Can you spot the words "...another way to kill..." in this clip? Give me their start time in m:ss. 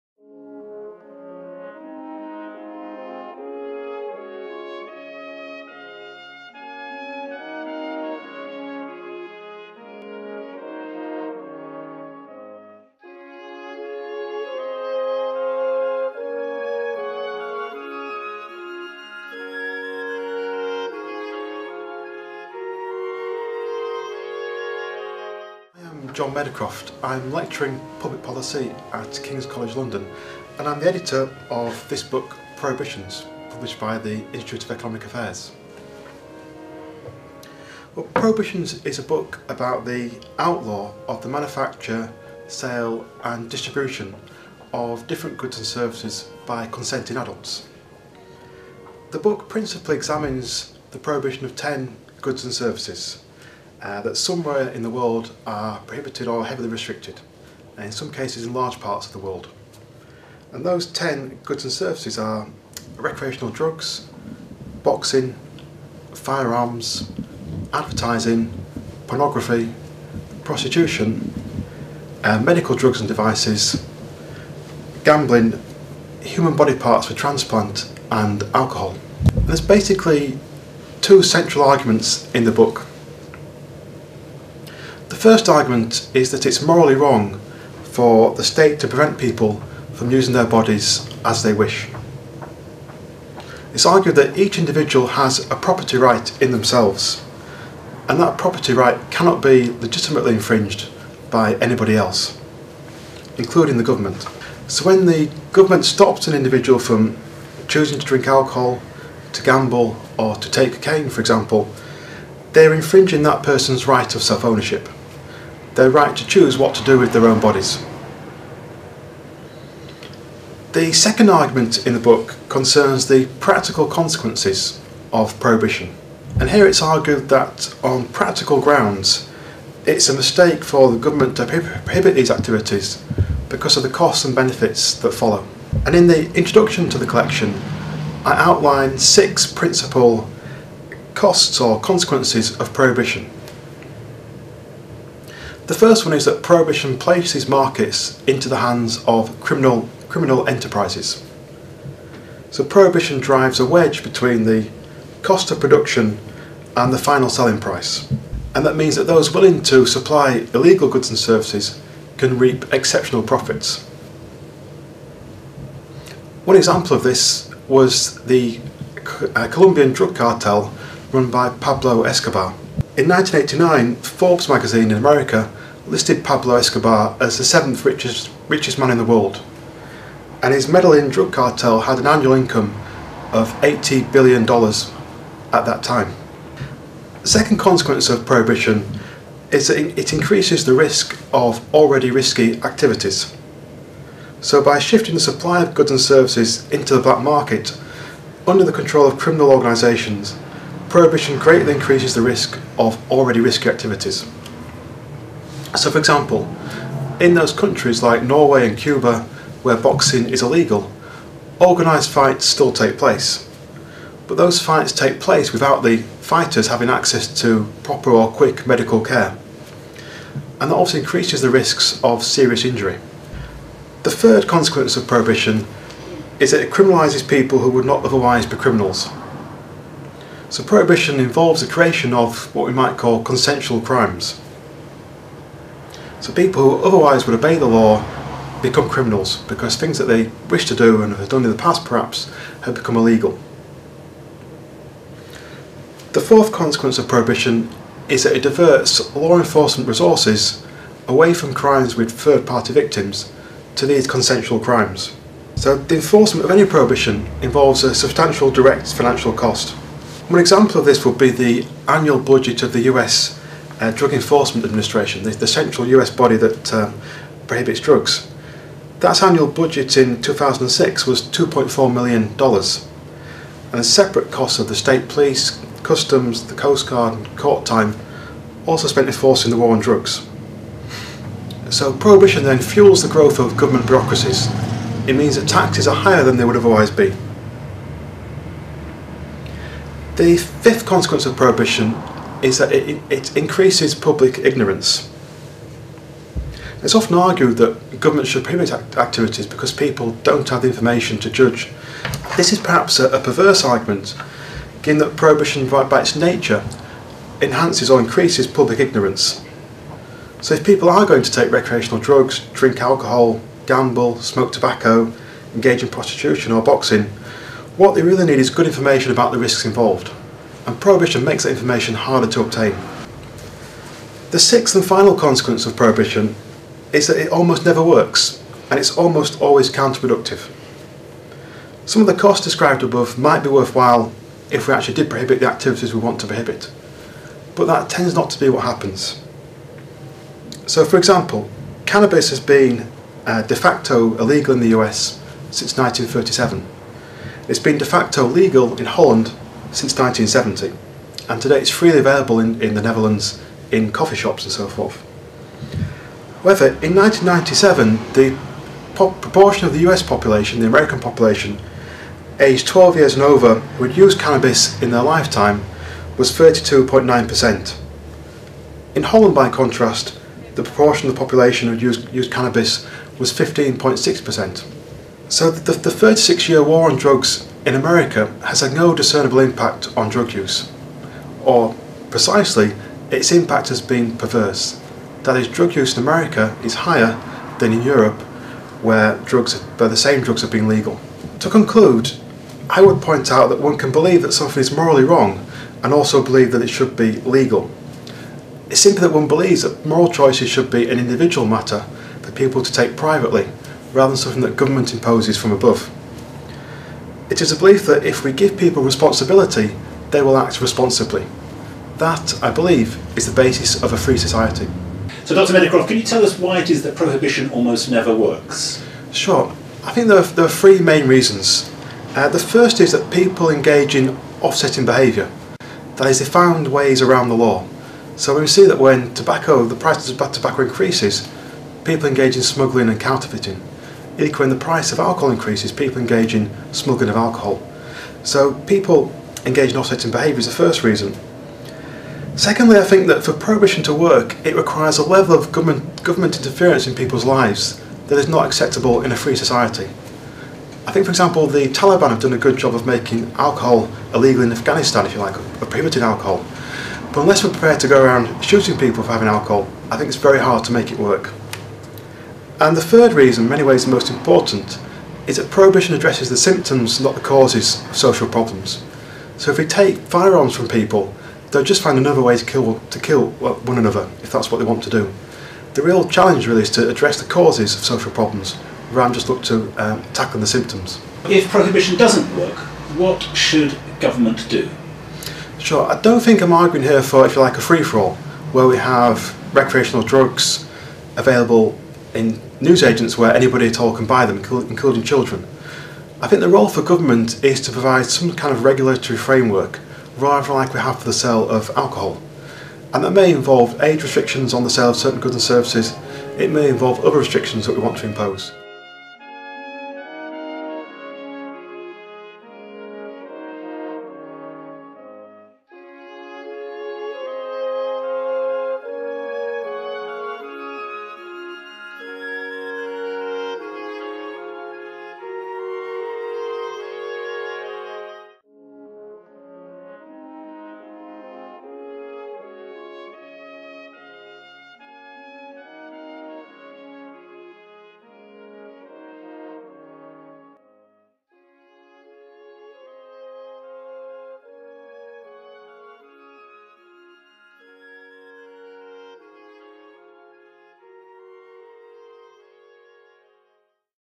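7:51.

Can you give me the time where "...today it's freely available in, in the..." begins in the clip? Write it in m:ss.
5:51.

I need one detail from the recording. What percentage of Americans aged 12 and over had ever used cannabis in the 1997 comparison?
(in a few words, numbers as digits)
32.9%.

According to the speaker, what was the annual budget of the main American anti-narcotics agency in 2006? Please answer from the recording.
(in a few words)
$2.4 million.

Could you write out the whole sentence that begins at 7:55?
The real challenge really is to address the causes of social problems, rather than just look to um, tackling the symptoms.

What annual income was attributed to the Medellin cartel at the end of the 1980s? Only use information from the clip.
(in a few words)
$80 billion.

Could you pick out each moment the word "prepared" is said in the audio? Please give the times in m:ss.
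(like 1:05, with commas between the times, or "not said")
7:37.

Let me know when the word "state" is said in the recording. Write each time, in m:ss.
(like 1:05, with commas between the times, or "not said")
1:28, 4:34.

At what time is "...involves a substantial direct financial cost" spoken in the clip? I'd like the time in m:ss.
4:17.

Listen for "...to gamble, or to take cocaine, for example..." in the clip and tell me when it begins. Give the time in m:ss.
1:49.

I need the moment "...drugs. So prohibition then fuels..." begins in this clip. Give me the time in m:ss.
4:39.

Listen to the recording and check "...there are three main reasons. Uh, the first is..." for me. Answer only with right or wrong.
right.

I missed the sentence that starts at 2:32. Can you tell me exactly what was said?
So prohibition drives a wedge between the cost of production and the final selling price.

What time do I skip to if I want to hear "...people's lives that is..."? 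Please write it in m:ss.
7:26.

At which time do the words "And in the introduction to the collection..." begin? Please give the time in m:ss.
2:15.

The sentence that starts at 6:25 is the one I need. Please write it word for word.
That is, drug use in America is higher than in Europe, where drugs, where the same drugs have been legal.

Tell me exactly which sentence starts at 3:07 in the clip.
The second consequence of prohibition is that it increases the risk of already risky activities.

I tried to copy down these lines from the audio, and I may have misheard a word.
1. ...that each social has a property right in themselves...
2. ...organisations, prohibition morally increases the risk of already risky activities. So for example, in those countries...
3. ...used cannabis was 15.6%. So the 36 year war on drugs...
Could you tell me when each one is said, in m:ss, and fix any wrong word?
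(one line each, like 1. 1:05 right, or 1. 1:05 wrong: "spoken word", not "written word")
1. 1:34 wrong: "individual", not "social"
2. 3:19 wrong: "greatly", not "morally"
3. 6:12 right.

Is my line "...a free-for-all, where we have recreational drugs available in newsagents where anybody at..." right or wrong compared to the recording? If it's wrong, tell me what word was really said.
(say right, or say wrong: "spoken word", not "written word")
right.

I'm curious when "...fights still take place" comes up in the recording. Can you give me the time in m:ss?
3:32.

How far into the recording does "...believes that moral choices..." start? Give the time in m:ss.
6:39.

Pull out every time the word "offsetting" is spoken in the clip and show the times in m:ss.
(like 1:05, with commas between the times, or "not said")
7:04, 7:19.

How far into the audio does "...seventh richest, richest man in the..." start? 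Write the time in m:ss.
2:57.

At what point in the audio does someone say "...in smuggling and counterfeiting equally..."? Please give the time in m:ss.
7:12.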